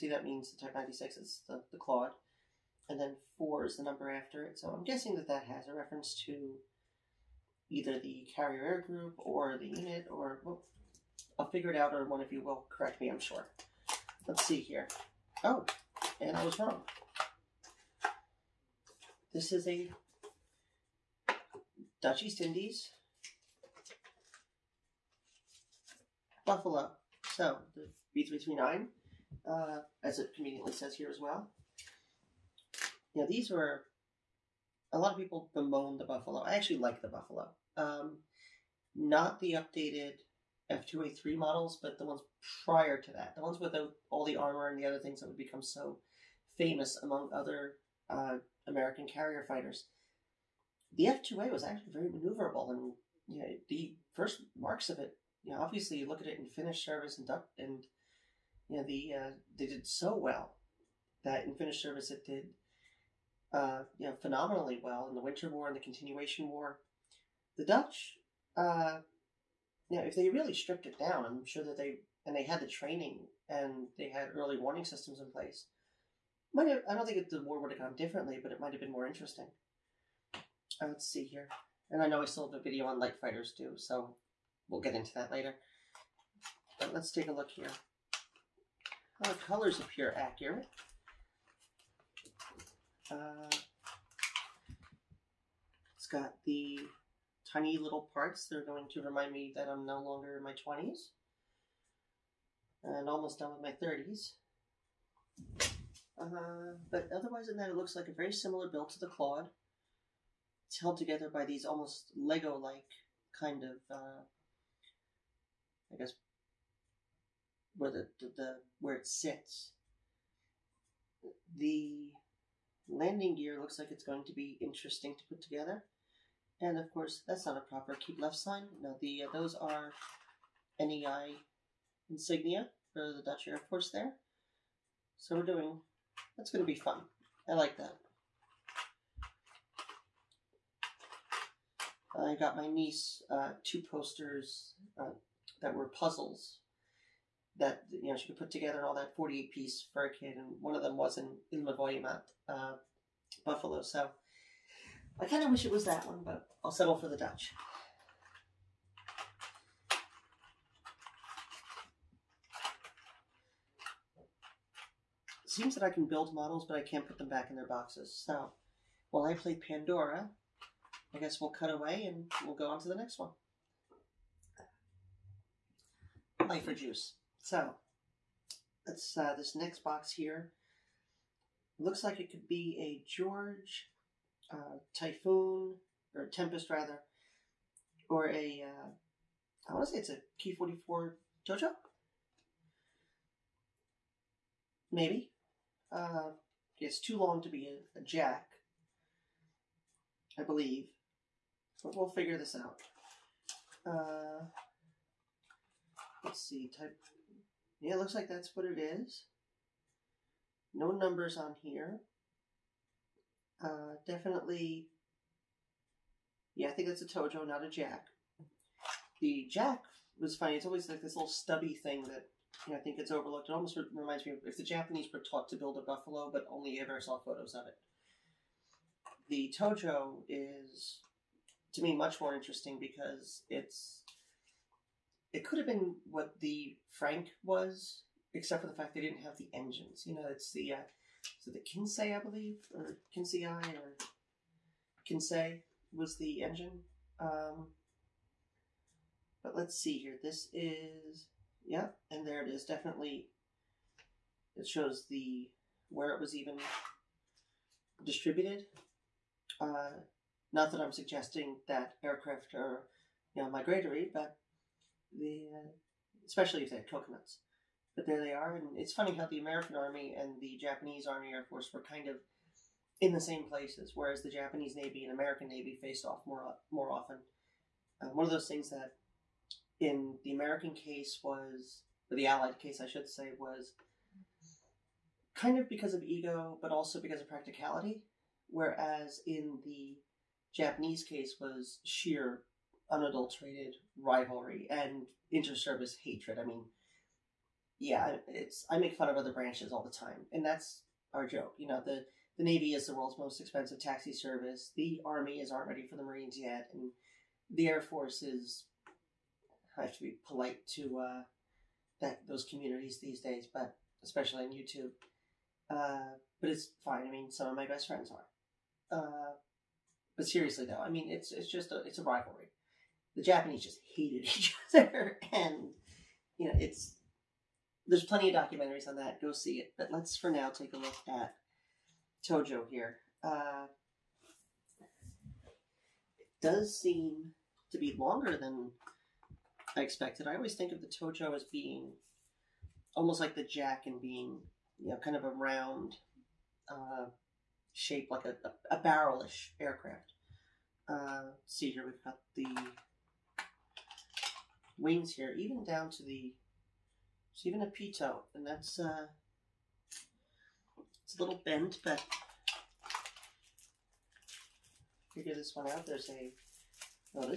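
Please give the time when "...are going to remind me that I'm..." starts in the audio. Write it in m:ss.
1:38.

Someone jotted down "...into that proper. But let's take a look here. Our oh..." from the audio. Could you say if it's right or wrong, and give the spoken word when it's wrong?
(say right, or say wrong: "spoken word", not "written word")
wrong: "later", not "proper".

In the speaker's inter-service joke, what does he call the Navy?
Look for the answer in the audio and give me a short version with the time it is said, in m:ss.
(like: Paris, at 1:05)
world's most expensive taxi service, at 5:02.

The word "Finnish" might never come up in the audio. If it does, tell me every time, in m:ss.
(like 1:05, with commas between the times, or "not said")
0:56, 1:01.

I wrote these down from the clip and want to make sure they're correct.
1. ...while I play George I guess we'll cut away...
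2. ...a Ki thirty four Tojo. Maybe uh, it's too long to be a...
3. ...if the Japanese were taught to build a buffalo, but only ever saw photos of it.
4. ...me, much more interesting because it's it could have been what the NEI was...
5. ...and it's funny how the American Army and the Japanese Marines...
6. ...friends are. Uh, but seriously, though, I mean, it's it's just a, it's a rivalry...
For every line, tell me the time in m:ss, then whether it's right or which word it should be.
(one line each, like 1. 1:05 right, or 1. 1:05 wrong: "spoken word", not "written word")
1. 2:49 wrong: "Pandora", not "George"
2. 3:10 wrong: "forty", not "thirty"
3. 3:44 right
4. 3:51 wrong: "Frank", not "NEI"
5. 4:28 wrong: "Army", not "Marines"
6. 5:17 right.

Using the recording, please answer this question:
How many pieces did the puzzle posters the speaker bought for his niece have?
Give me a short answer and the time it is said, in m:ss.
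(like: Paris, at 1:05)
48, at 2:29.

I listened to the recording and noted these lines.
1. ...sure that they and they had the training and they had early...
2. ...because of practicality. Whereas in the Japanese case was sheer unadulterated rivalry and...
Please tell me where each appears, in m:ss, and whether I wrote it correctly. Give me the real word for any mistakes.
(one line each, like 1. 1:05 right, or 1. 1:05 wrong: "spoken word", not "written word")
1. 1:11 right
2. 4:47 right.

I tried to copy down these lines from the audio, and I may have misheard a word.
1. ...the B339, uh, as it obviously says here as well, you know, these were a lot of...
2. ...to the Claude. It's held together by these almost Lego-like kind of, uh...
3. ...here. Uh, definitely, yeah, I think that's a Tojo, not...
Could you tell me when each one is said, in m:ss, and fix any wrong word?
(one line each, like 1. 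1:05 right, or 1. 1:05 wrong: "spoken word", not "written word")
1. 0:27 wrong: "conveniently", not "obviously"
2. 1:48 right
3. 3:31 right.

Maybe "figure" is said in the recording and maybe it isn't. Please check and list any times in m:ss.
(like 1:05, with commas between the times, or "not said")
0:11, 3:22, 6:05.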